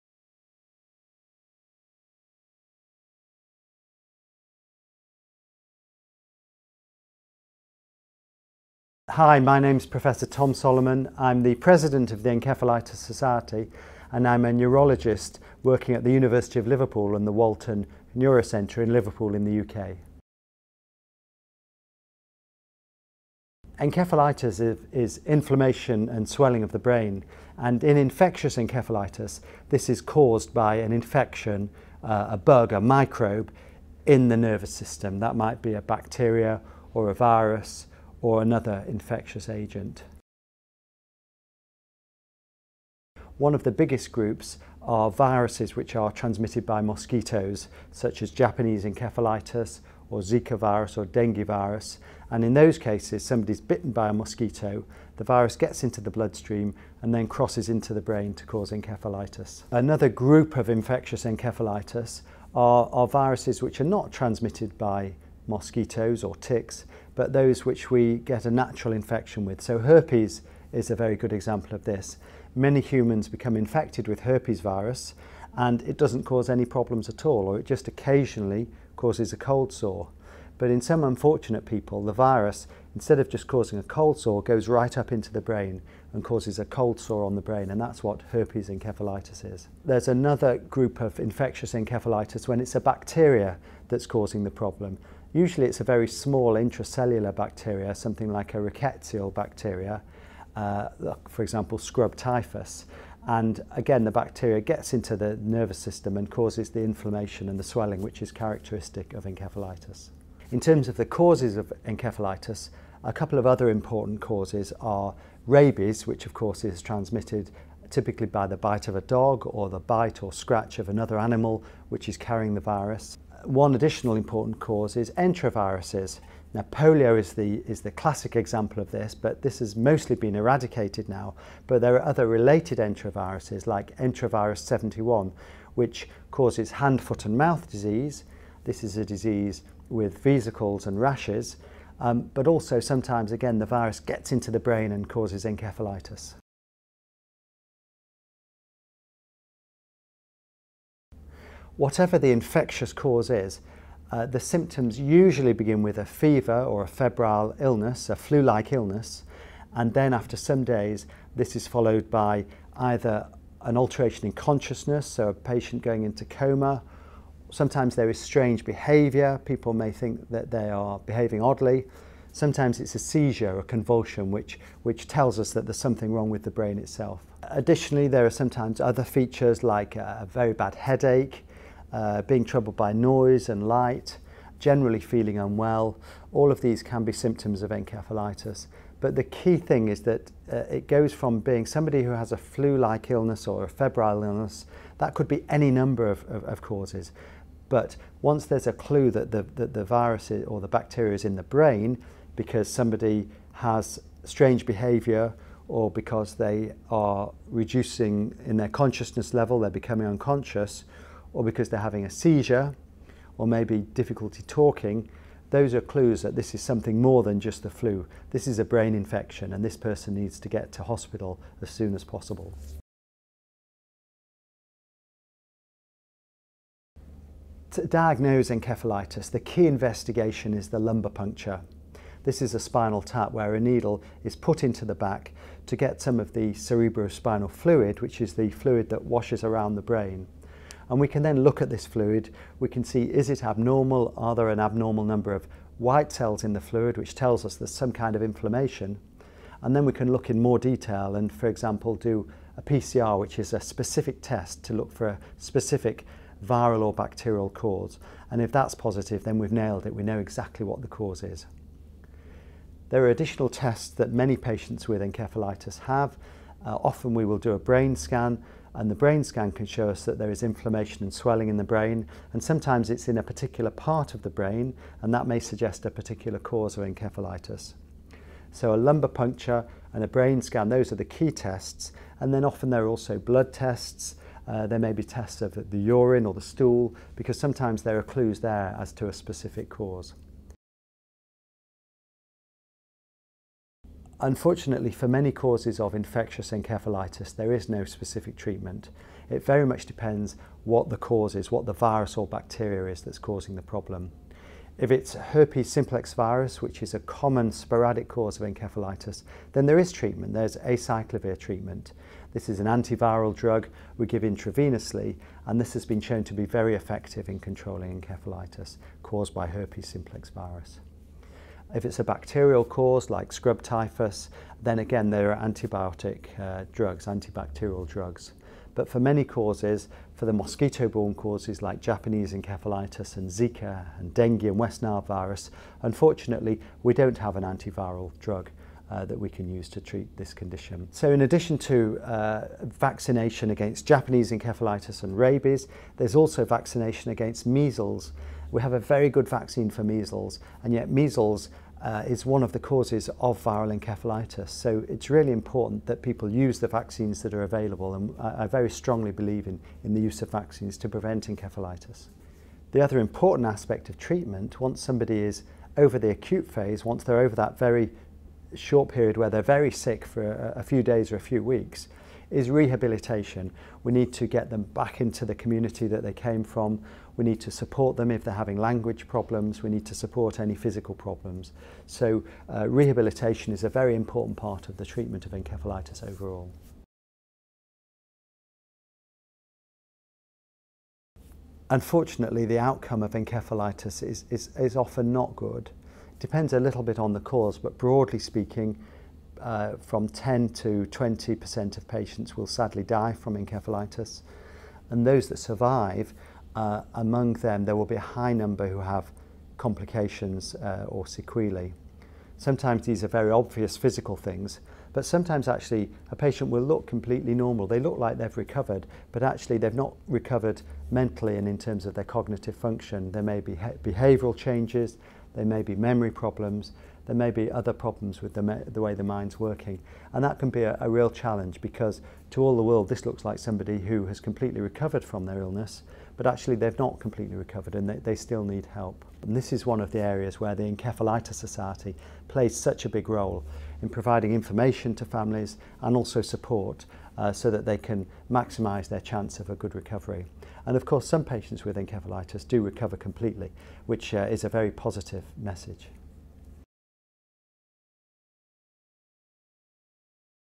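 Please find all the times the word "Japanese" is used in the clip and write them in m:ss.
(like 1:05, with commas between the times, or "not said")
0:48, 5:31, 5:43.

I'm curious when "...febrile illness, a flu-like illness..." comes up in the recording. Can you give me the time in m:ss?
2:36.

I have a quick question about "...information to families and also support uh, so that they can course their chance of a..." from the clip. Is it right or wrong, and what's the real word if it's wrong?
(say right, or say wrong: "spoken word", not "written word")
wrong: "maximise", not "course".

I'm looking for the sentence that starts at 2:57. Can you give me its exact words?
Additionally, there are sometimes other features like a very bad headache, uh, being troubled by noise and light, generally feeling unwell.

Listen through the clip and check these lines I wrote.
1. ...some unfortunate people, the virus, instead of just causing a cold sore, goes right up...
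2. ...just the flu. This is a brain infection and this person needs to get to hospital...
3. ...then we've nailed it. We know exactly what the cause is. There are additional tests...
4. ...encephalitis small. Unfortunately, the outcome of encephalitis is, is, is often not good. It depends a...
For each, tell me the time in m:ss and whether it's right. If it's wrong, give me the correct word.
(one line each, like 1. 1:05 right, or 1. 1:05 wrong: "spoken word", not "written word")
1. 1:20 right
2. 3:37 right
3. 4:19 right
4. 6:25 wrong: "overall", not "small".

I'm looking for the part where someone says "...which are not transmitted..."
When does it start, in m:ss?
1:03.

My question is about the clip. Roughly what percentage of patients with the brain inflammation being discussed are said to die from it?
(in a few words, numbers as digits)
10 to 20%.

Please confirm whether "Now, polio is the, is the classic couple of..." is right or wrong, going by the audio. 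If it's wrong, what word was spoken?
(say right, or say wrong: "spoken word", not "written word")
wrong: "example", not "couple".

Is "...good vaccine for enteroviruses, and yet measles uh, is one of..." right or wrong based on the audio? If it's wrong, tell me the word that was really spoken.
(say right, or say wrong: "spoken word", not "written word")
wrong: "measles", not "enteroviruses".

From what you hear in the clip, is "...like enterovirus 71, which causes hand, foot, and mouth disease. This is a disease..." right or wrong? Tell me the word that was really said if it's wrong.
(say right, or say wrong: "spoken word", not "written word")
right.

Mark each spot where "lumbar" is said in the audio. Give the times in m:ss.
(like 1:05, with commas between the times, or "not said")
3:50, 4:38.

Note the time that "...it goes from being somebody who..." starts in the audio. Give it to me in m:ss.
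3:10.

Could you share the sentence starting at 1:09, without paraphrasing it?
So herpes is a very good example of this.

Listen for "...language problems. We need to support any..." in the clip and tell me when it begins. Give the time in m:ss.
6:18.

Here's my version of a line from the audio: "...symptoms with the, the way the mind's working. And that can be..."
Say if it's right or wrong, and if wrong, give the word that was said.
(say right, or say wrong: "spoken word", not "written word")
wrong: "problems", not "symptoms".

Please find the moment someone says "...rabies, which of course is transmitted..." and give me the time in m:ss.
1:55.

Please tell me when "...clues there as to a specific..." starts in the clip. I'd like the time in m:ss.
4:48.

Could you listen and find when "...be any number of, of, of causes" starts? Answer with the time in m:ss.
3:15.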